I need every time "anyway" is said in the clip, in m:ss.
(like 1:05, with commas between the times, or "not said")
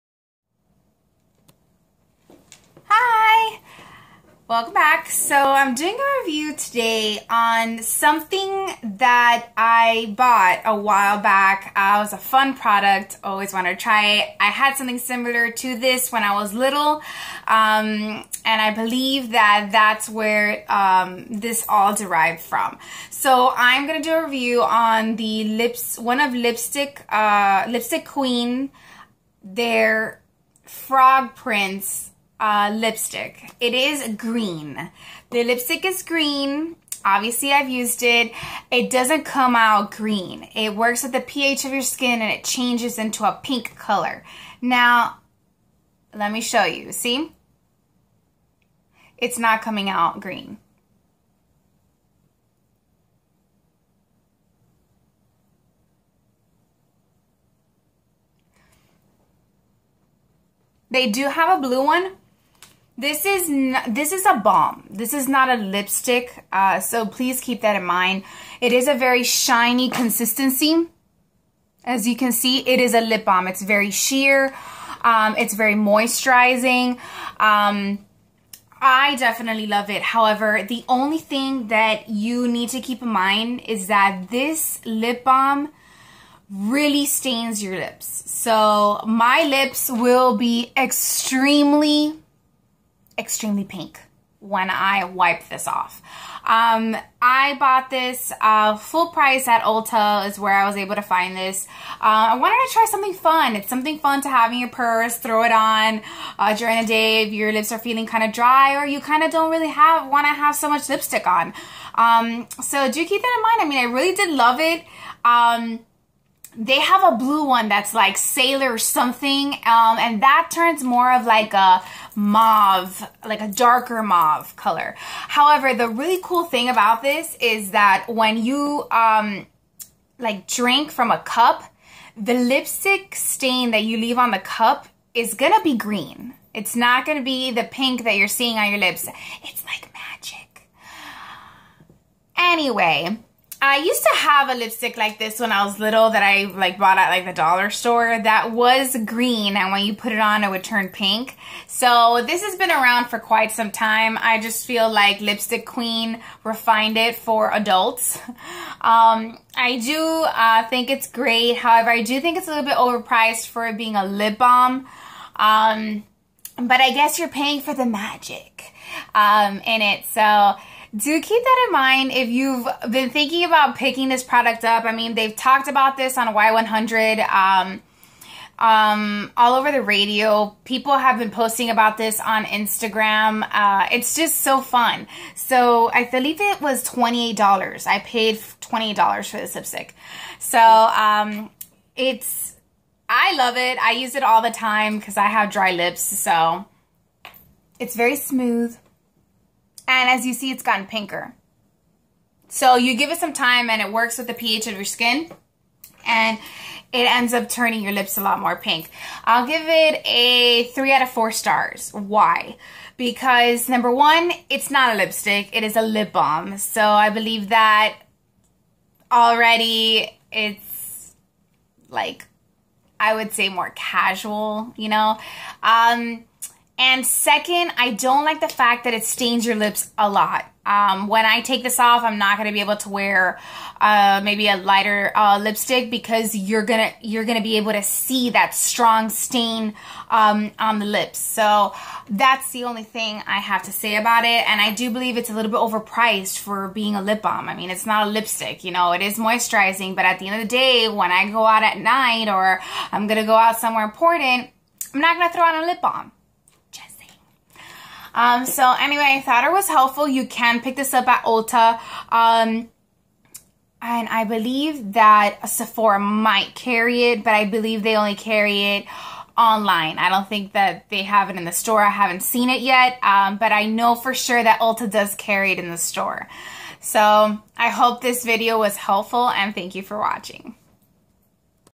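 2:22, 4:18.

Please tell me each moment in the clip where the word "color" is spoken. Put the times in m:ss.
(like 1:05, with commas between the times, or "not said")
0:43, 2:04.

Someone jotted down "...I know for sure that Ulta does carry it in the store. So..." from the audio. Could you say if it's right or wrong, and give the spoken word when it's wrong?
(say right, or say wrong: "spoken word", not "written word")
right.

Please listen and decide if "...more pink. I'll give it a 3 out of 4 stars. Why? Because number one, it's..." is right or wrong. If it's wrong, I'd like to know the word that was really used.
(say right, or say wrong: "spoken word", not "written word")
right.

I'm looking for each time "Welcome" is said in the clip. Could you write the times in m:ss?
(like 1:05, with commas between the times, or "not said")
0:04.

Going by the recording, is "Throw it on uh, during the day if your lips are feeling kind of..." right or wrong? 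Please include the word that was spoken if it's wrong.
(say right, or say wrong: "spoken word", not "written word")
right.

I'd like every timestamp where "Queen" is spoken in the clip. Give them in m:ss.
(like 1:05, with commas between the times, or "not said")
0:28, 2:35.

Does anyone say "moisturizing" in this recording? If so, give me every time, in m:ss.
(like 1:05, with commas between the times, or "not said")
1:15, 4:09.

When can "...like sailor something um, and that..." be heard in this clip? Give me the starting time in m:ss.
1:57.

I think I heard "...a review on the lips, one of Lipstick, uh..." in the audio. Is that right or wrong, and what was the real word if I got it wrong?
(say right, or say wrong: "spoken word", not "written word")
right.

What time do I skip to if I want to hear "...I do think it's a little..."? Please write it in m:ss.
2:41.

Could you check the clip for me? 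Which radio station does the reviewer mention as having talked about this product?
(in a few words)
Y100.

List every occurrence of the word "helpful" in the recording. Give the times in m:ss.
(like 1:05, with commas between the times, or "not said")
4:19, 4:38.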